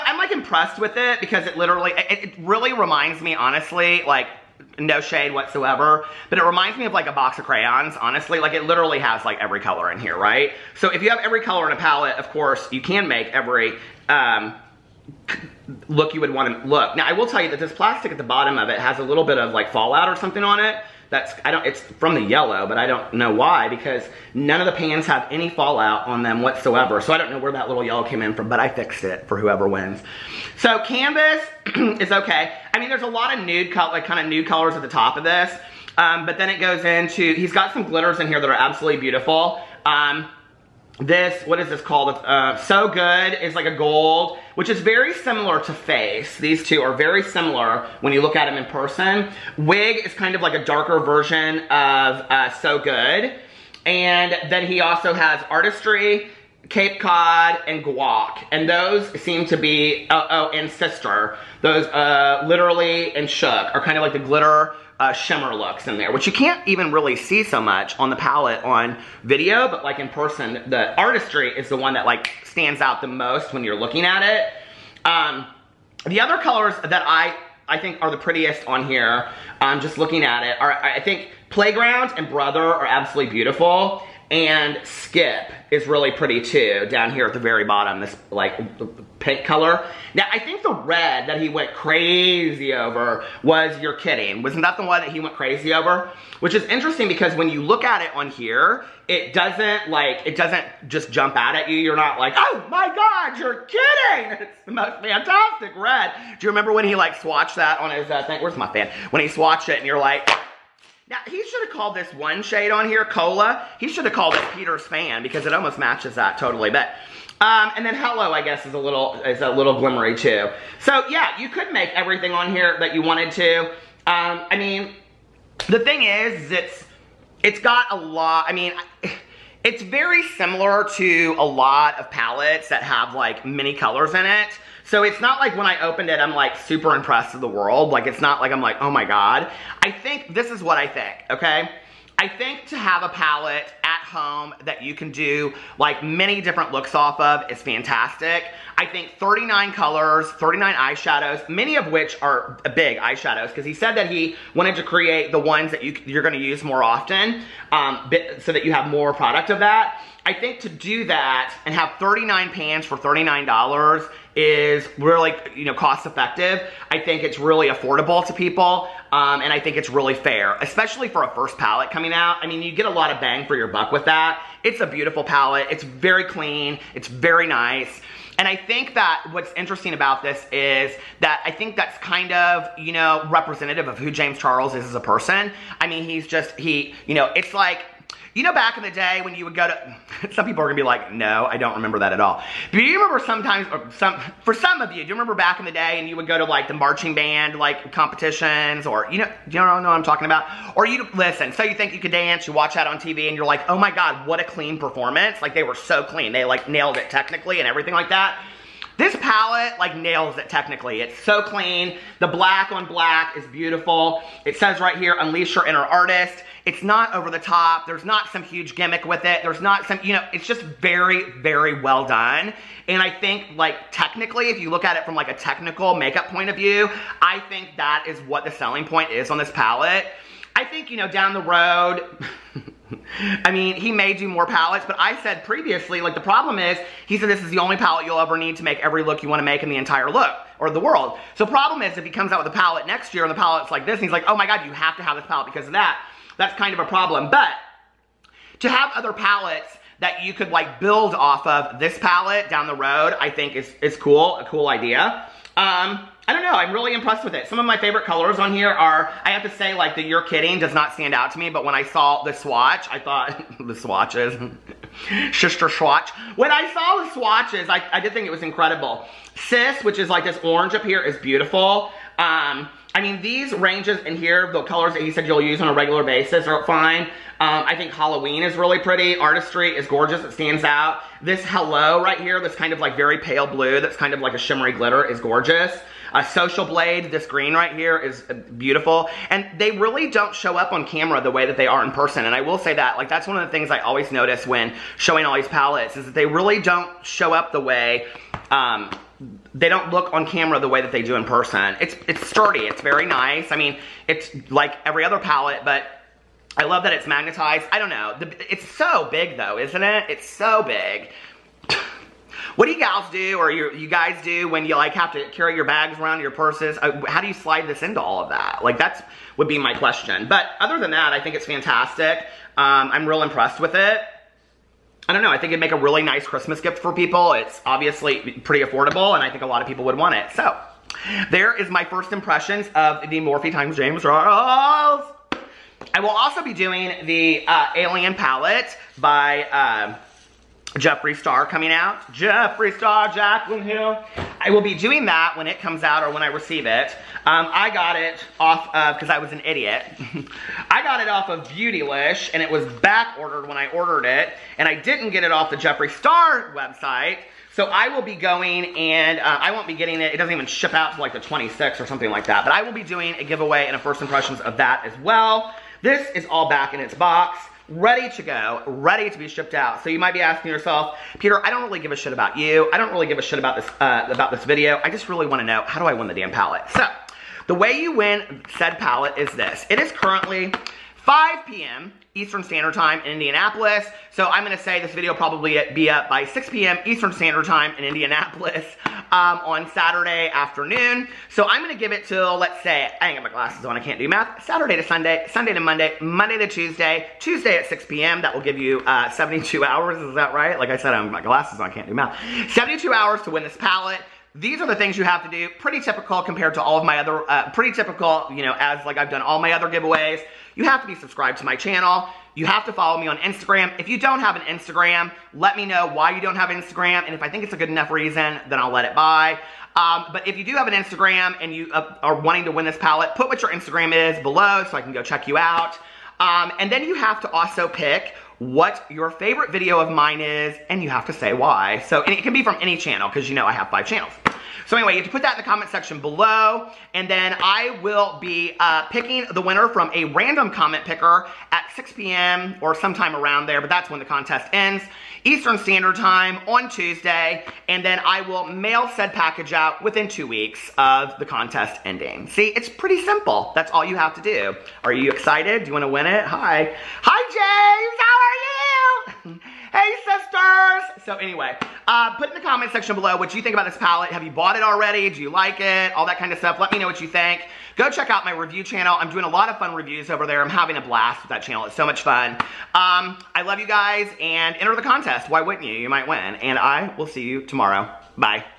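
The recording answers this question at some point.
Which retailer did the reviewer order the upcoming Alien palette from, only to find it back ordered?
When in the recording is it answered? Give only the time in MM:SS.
05:51.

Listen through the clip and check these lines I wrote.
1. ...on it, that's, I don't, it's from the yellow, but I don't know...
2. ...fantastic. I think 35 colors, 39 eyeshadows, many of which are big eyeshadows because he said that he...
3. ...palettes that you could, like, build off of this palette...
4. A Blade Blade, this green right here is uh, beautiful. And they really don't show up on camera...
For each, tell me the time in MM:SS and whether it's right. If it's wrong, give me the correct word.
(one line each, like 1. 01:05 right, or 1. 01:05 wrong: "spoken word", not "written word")
1. 00:20 right
2. 02:27 wrong: "39", not "35"
3. 04:09 right
4. 04:46 wrong: "Social", not "Blade".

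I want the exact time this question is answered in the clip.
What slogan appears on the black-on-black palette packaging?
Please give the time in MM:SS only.
03:35.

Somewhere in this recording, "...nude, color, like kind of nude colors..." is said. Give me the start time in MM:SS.
00:33.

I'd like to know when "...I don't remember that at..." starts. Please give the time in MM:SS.
03:11.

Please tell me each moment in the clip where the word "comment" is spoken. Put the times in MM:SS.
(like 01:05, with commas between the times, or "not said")
07:15, 07:20, 07:42.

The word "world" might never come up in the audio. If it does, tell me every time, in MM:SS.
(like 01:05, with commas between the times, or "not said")
02:17, 04:00.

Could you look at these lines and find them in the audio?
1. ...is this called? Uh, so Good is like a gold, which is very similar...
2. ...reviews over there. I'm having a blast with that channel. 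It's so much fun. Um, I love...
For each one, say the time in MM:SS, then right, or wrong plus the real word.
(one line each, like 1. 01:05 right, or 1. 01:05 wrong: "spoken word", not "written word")
1. 00:41 right
2. 07:49 right.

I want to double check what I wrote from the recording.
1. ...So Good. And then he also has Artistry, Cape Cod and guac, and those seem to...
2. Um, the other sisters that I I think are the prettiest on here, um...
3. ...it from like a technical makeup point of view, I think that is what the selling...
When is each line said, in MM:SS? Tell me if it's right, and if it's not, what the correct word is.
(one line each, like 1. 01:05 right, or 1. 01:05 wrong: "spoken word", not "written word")
1. 00:52 right
2. 01:15 wrong: "colors", not "sisters"
3. 03:44 right.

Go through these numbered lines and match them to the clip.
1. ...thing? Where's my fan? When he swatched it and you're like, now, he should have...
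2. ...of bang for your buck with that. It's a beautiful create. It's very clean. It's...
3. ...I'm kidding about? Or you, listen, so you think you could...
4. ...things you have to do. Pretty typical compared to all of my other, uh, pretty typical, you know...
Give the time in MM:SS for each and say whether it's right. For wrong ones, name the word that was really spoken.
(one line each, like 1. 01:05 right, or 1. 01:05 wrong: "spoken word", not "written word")
1. 01:48 right
2. 02:53 wrong: "palette", not "create"
3. 03:19 wrong: "talking", not "kidding"
4. 06:44 right.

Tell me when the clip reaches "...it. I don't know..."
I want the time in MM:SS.
05:23.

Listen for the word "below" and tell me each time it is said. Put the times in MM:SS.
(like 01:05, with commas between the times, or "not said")
07:04, 07:15, 07:42.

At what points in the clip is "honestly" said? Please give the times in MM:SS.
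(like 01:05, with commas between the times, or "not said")
00:03, 00:07.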